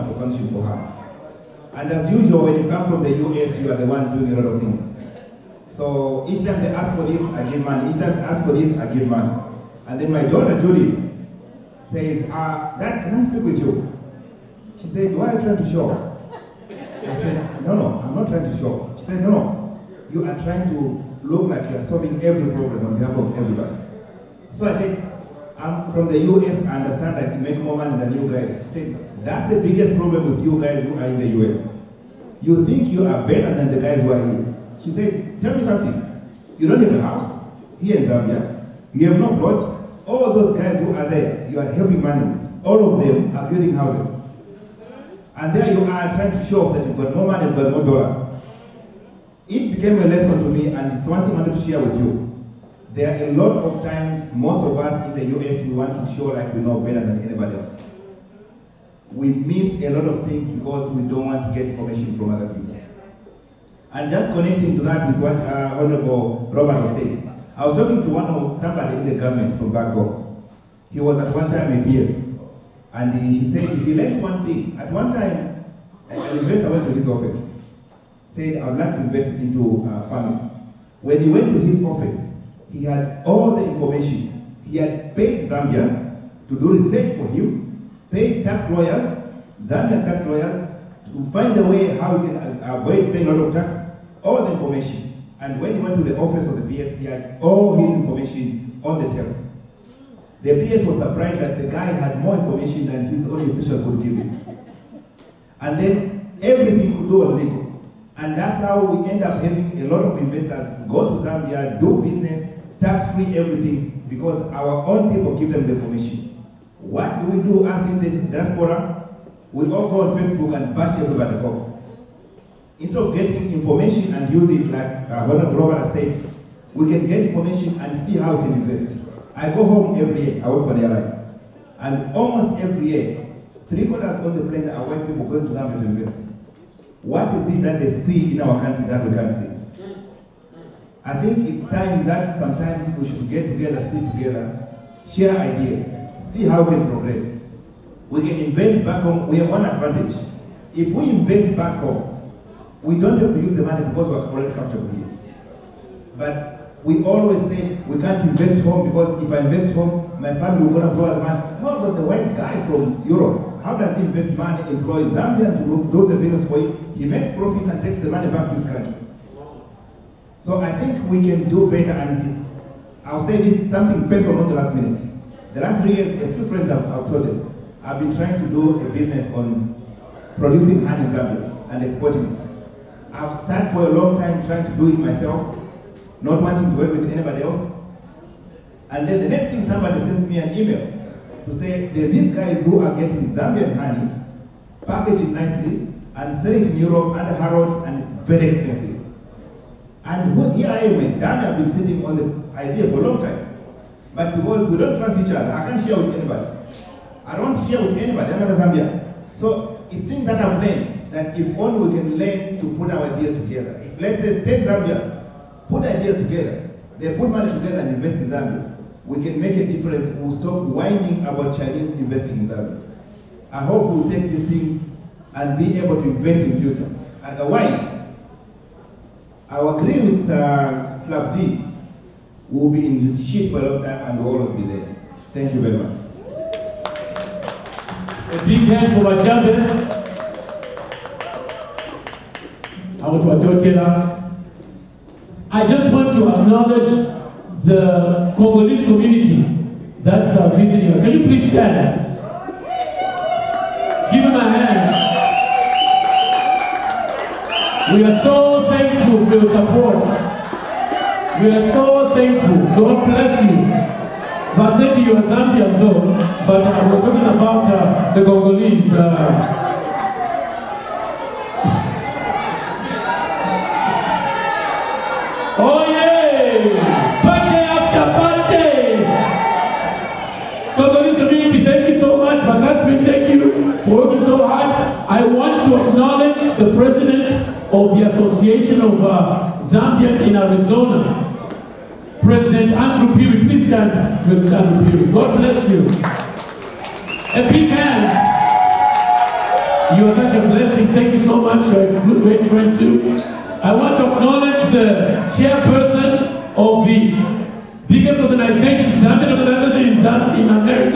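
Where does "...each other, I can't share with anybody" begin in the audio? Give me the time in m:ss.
3:25.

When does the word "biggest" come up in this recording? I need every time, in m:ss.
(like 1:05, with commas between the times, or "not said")
0:29, 5:07.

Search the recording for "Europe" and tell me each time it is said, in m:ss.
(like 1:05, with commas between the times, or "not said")
2:43, 3:16.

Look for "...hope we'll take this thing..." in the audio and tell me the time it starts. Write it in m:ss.
3:43.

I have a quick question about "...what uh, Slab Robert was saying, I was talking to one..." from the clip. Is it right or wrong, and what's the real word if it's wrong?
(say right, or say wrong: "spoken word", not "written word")
wrong: "Honorable", not "Slab".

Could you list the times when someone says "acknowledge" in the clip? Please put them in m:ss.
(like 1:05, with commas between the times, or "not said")
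4:06, 5:04.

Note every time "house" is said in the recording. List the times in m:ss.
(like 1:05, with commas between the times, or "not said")
0:37, 0:43.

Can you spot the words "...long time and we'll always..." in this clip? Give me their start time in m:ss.
3:53.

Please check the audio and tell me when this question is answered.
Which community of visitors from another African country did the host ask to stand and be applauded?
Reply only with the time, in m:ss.
4:08.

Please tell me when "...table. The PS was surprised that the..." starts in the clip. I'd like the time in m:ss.
1:39.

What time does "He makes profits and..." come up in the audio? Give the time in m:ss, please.
2:46.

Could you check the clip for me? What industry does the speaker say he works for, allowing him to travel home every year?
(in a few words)
The airline.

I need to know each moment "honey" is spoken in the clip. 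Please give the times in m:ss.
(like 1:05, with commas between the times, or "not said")
3:00, 3:13.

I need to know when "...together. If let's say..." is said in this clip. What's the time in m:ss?
3:33.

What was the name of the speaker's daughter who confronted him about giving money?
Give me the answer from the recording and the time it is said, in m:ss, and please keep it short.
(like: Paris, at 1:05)
Julie, at 0:10.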